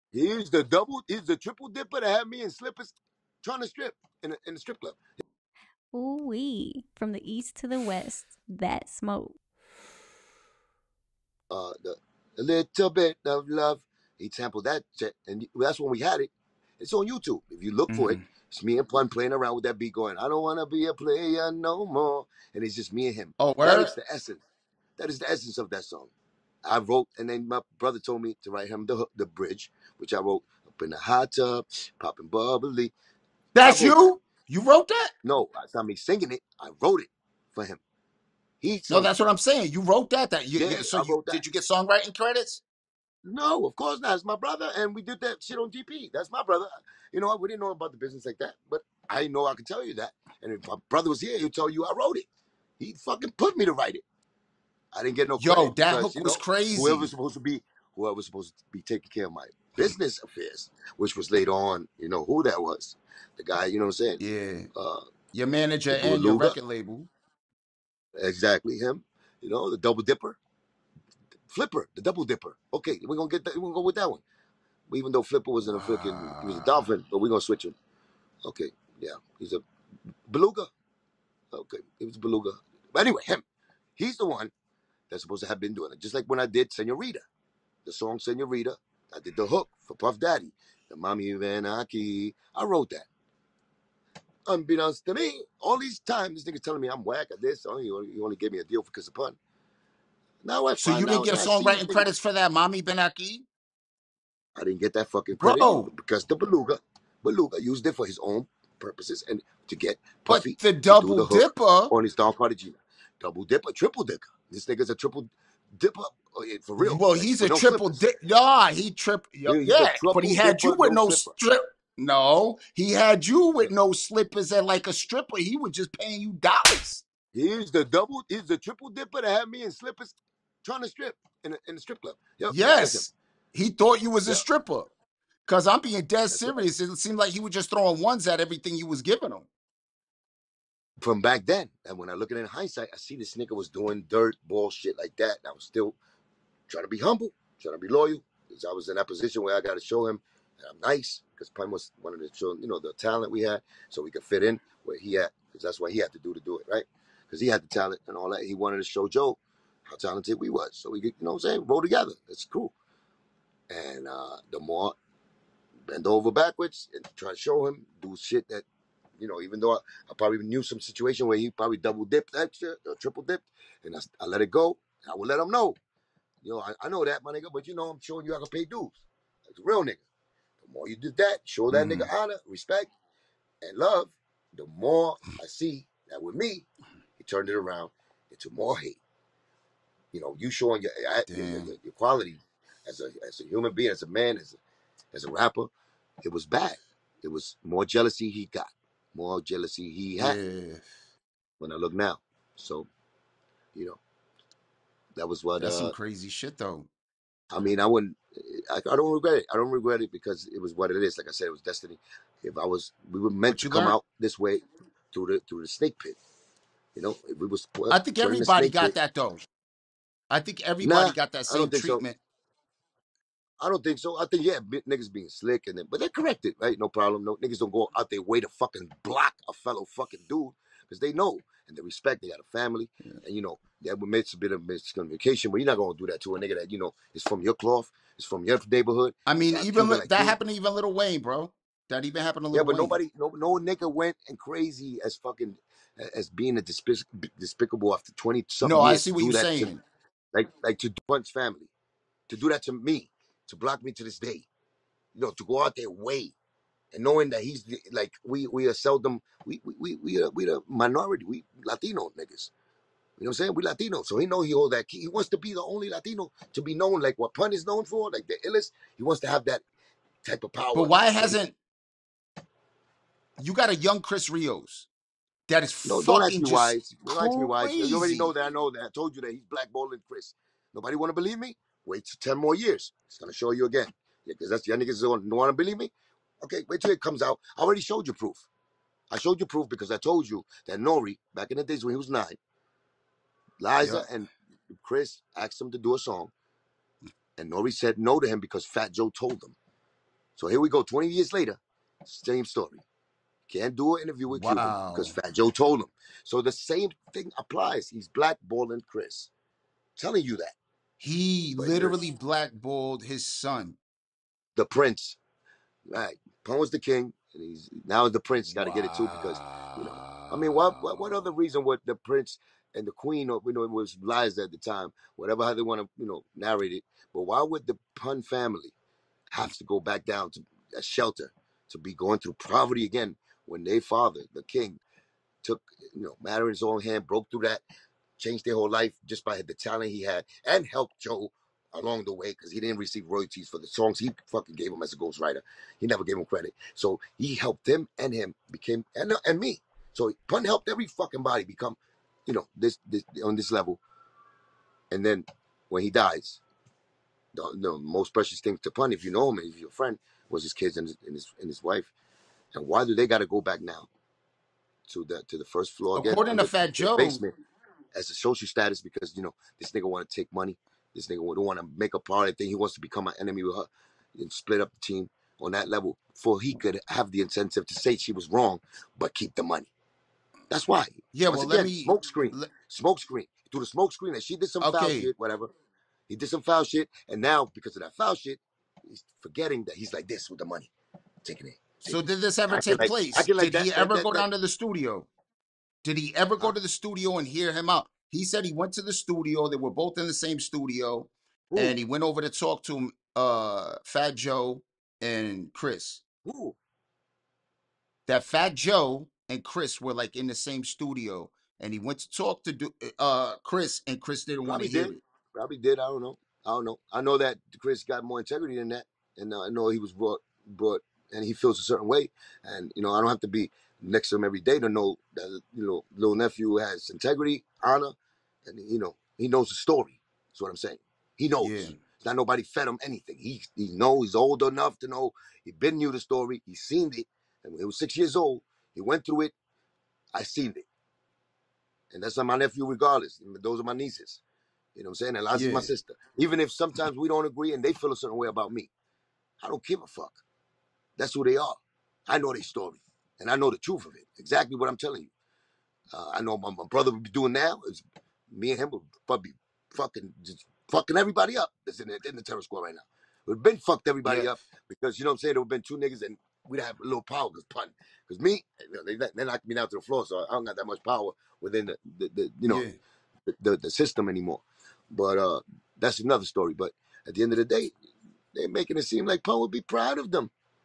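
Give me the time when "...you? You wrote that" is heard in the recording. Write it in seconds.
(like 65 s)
33 s.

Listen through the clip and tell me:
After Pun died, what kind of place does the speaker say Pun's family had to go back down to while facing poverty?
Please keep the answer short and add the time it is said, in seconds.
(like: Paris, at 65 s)
a shelter, at 330 s.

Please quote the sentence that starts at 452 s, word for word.
I know their story, and I know the truth of it.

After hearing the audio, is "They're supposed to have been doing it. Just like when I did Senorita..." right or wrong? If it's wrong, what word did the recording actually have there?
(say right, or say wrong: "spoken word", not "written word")
right.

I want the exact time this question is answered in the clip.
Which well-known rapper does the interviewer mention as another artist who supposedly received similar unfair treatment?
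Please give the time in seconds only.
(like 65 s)
240 s.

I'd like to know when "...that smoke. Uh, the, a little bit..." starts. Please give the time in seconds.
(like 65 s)
8 s.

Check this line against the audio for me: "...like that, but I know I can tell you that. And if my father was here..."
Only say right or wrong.
wrong.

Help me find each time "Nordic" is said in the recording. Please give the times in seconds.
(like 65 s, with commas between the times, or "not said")
not said.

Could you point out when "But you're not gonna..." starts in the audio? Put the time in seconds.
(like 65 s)
235 s.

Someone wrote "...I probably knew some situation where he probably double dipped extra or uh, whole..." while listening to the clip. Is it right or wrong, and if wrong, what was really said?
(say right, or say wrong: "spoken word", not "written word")
wrong: "triple", not "whole".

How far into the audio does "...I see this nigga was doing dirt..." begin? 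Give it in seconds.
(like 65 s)
142 s.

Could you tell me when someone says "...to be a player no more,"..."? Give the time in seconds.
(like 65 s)
20 s.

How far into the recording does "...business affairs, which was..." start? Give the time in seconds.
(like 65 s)
59 s.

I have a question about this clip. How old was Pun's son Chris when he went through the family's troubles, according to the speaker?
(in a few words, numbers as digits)
6.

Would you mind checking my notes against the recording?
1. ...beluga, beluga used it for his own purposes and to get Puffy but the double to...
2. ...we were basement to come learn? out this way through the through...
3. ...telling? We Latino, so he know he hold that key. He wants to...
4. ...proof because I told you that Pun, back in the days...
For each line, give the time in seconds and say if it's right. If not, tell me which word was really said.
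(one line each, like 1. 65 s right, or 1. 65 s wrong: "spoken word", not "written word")
1. 106 s right
2. 213 s wrong: "meant", not "basement"
3. 263 s wrong: "saying", not "telling"
4. 289 s wrong: "Nore", not "Pun".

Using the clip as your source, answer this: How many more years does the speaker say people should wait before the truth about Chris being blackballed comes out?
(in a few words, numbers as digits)
10.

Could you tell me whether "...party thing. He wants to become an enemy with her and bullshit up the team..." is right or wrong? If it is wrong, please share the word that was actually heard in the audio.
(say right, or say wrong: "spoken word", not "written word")
wrong: "split", not "bullshit".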